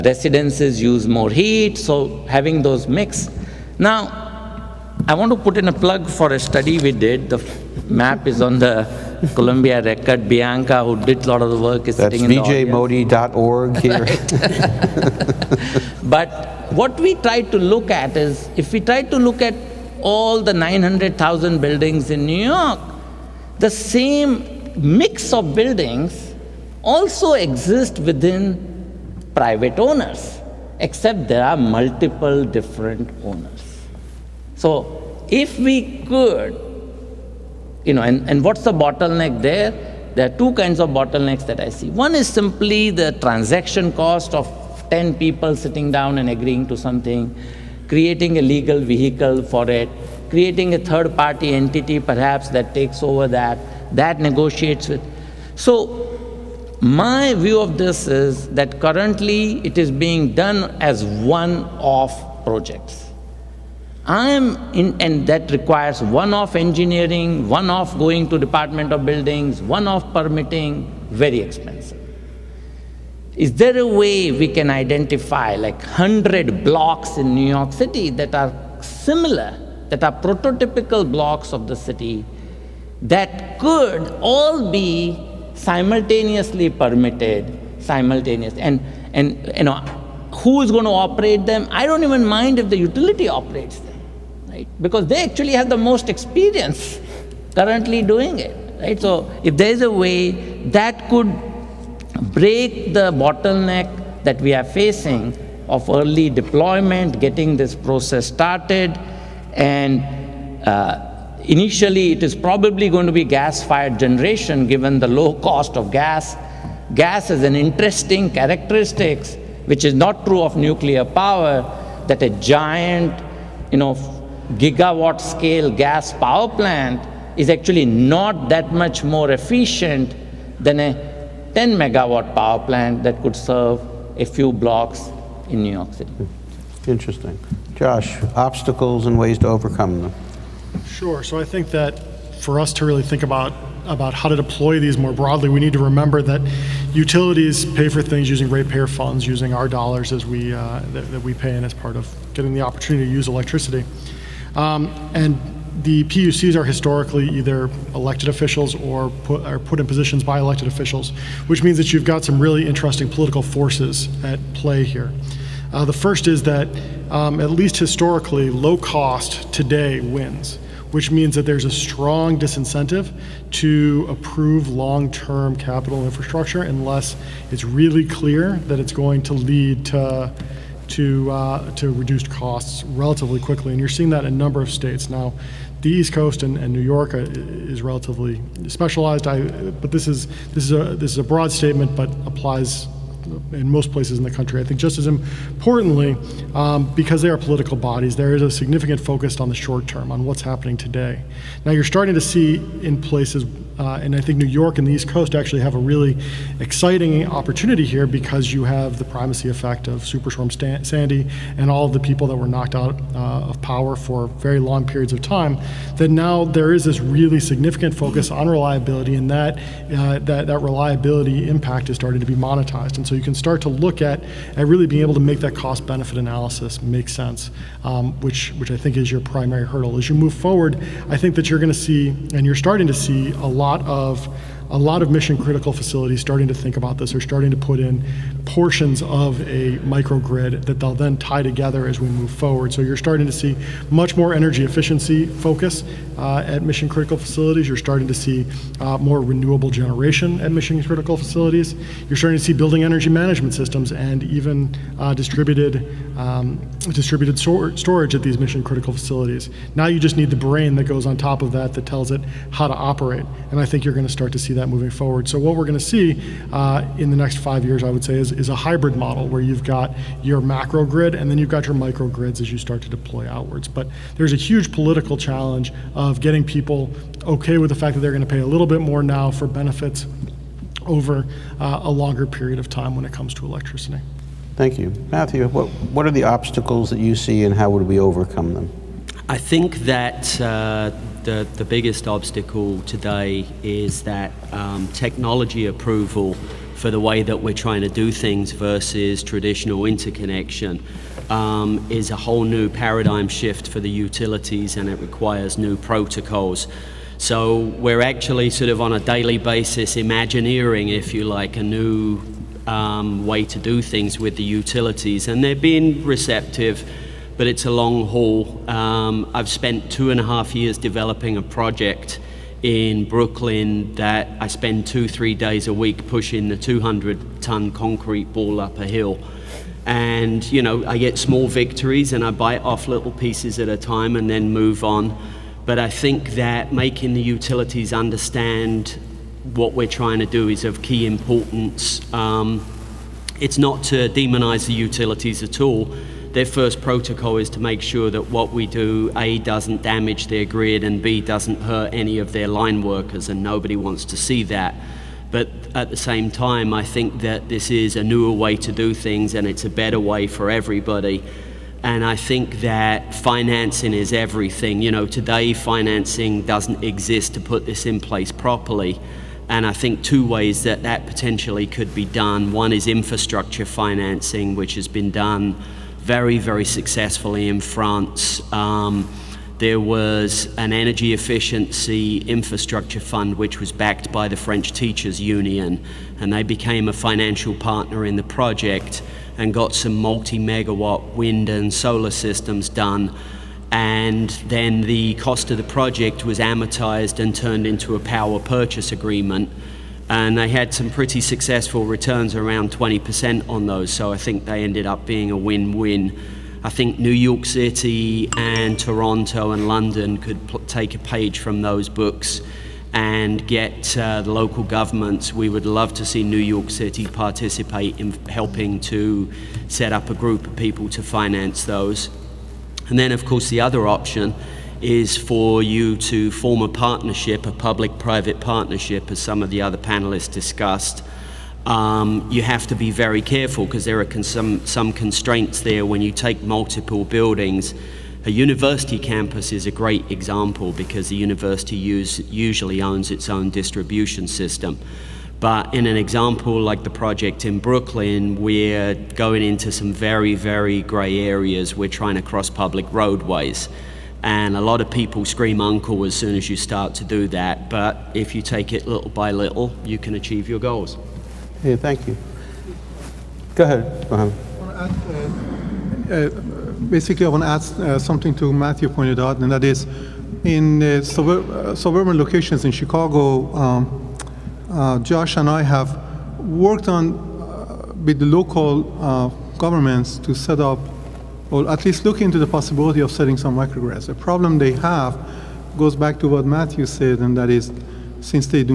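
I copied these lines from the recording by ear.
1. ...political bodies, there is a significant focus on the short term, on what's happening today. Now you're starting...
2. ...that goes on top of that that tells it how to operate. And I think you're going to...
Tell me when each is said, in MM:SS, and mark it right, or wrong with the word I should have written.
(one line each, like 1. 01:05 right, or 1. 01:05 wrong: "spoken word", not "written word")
1. 03:17 right
2. 04:20 right.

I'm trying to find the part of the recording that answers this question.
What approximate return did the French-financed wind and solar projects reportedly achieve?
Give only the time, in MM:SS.
06:42.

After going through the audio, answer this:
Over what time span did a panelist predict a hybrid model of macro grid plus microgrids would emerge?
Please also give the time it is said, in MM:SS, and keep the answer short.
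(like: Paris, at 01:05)
five years, at 04:27.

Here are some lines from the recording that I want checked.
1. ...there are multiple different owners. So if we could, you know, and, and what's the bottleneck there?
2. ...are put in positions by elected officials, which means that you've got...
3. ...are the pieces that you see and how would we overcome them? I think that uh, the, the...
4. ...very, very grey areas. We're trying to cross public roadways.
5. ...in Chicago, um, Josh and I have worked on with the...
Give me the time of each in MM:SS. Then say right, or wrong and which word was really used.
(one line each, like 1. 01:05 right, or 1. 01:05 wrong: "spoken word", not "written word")
1. 00:31 right
2. 02:39 right
3. 04:46 wrong: "obstacles", not "pieces"
4. 07:29 right
5. 07:52 right.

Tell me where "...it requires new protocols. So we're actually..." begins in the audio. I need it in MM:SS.
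05:04.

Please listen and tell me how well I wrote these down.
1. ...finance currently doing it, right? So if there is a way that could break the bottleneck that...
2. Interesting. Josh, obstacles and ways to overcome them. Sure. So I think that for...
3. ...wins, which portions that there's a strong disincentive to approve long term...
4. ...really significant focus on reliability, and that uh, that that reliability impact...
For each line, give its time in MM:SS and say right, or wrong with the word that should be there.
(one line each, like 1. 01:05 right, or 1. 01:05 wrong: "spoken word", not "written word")
1. 01:36 wrong: "experience", not "finance"
2. 02:16 right
3. 02:49 wrong: "means", not "portions"
4. 03:36 right.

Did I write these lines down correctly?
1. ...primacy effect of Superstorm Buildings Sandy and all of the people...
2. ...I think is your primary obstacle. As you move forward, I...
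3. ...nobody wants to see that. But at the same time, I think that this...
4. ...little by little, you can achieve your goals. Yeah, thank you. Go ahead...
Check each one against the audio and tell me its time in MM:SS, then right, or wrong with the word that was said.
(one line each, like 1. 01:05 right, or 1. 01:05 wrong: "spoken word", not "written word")
1. 03:29 wrong: "Stan", not "Buildings"
2. 03:48 wrong: "hurdle", not "obstacle"
3. 05:53 right
4. 07:38 right.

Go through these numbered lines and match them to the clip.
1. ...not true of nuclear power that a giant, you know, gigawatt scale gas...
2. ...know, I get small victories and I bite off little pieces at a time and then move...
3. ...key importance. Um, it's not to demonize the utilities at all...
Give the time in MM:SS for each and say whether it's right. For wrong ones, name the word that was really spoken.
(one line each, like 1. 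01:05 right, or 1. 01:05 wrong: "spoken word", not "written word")
1. 01:59 right
2. 05:30 right
3. 05:40 right.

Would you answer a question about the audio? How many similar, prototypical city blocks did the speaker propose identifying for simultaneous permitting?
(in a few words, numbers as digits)
100.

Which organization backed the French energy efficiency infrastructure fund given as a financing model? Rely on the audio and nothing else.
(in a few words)
French Teachers Union.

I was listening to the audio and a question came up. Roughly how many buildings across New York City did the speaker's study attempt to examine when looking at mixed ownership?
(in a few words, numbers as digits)
900,000.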